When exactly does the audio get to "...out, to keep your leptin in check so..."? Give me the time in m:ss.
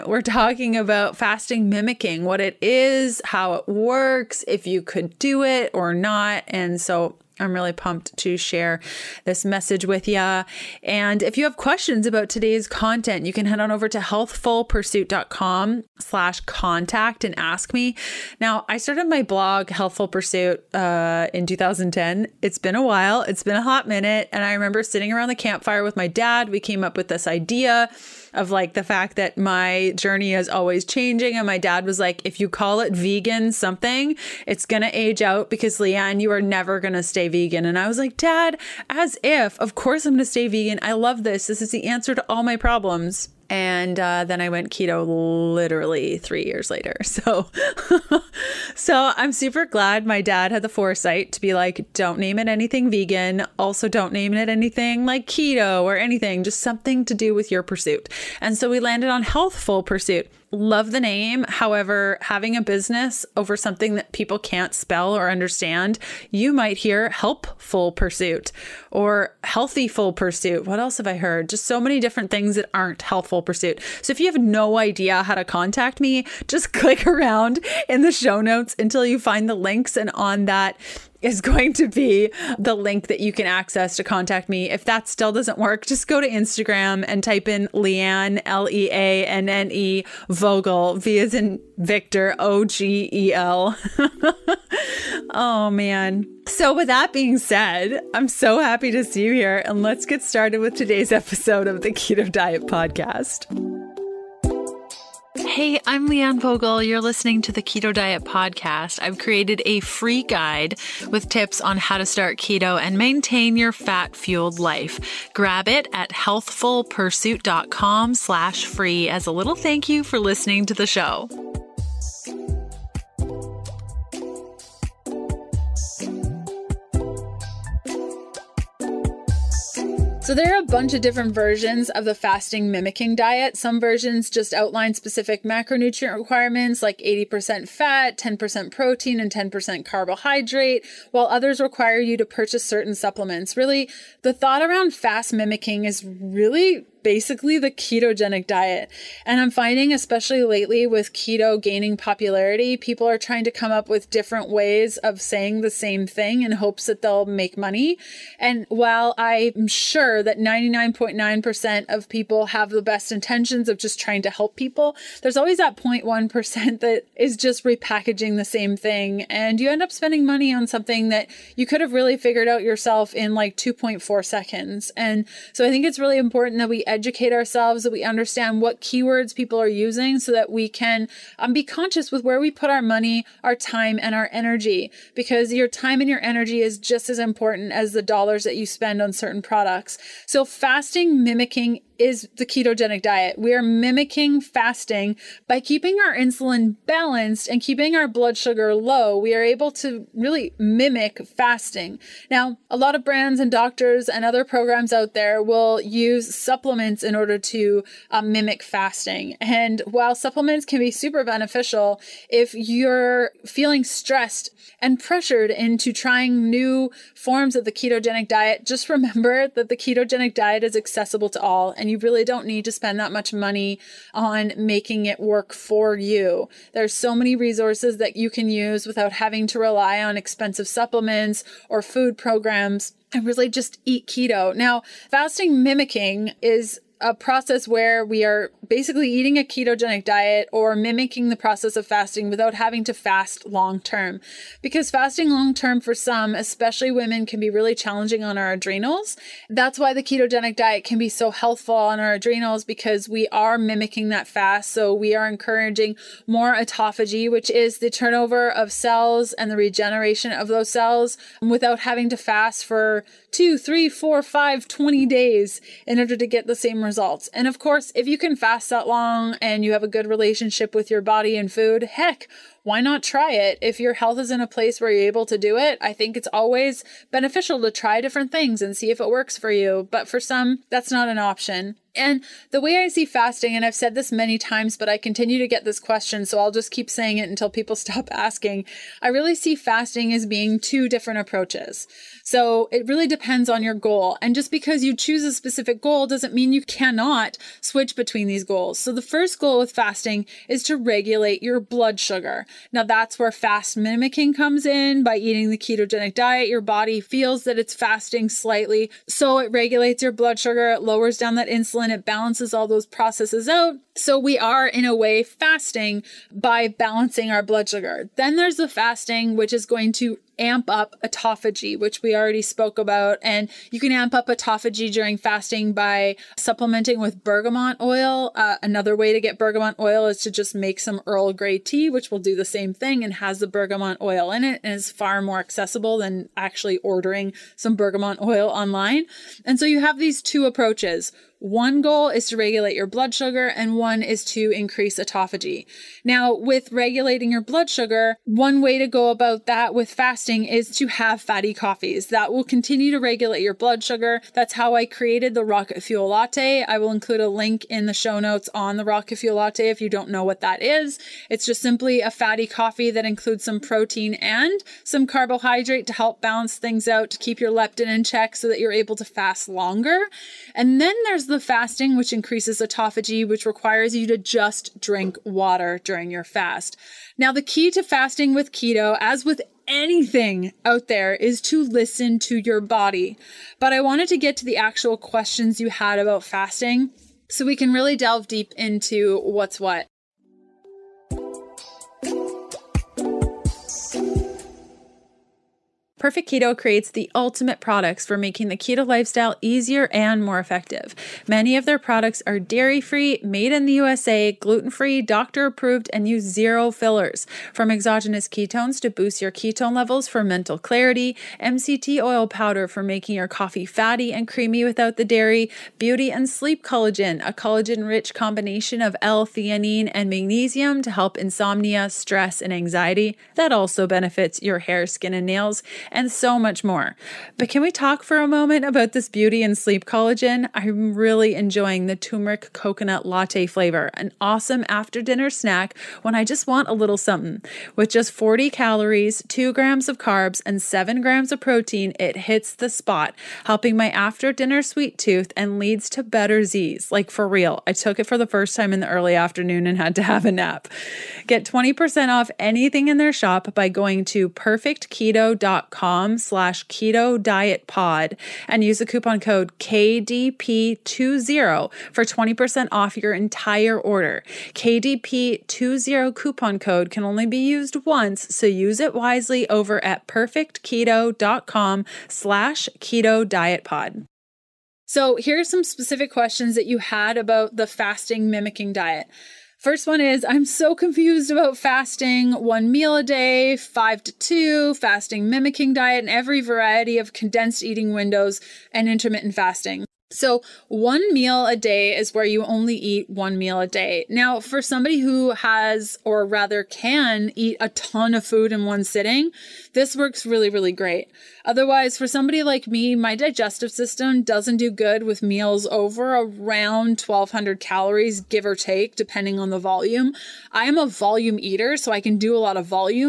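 6:06.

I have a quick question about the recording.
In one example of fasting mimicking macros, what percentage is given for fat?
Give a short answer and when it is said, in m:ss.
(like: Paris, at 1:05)
80%, at 2:16.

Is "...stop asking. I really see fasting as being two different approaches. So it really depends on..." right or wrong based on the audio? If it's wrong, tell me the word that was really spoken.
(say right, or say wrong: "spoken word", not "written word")
right.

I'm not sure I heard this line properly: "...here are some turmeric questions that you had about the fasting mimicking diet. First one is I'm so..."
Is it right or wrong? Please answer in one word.
wrong.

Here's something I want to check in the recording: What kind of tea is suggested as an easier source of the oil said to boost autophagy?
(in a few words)
Earl Grey.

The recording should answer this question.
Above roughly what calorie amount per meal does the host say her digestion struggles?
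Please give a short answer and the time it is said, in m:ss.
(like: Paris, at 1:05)
1200, at 8:27.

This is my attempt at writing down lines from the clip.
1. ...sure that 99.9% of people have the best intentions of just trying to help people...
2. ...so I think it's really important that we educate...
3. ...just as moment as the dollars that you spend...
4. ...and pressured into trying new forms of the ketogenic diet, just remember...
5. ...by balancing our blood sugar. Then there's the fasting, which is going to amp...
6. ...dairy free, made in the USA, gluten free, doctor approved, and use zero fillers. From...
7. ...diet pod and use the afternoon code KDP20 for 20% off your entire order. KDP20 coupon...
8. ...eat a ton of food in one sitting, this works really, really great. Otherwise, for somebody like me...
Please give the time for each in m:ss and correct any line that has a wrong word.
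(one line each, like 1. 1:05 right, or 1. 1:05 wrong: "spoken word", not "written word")
1. 2:39 right
2. 2:55 right
3. 3:06 wrong: "important", not "moment"
4. 3:34 right
5. 5:16 right
6. 6:42 right
7. 7:37 wrong: "coupon", not "afternoon"
8. 8:17 right.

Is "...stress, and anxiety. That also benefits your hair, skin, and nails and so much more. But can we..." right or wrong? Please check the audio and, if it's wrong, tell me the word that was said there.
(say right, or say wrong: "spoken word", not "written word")
right.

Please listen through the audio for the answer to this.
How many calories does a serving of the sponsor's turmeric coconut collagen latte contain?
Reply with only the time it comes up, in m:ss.
7:18.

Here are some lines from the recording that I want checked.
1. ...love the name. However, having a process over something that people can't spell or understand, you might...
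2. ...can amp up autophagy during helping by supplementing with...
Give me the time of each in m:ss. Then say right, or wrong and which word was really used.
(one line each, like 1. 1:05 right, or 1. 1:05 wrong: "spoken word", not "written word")
1. 1:00 wrong: "business", not "process"
2. 5:23 wrong: "fasting", not "helping".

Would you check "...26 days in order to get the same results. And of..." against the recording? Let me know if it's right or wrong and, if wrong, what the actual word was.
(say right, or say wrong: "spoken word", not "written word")
wrong: "20", not "26".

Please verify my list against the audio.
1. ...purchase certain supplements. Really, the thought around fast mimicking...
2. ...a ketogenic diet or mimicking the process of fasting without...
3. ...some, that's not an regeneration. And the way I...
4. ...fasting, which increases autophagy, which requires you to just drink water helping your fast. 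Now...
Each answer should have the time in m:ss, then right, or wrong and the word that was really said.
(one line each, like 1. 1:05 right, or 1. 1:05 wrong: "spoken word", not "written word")
1. 2:22 right
2. 3:59 right
3. 4:40 wrong: "option", not "regeneration"
4. 6:11 wrong: "during", not "helping".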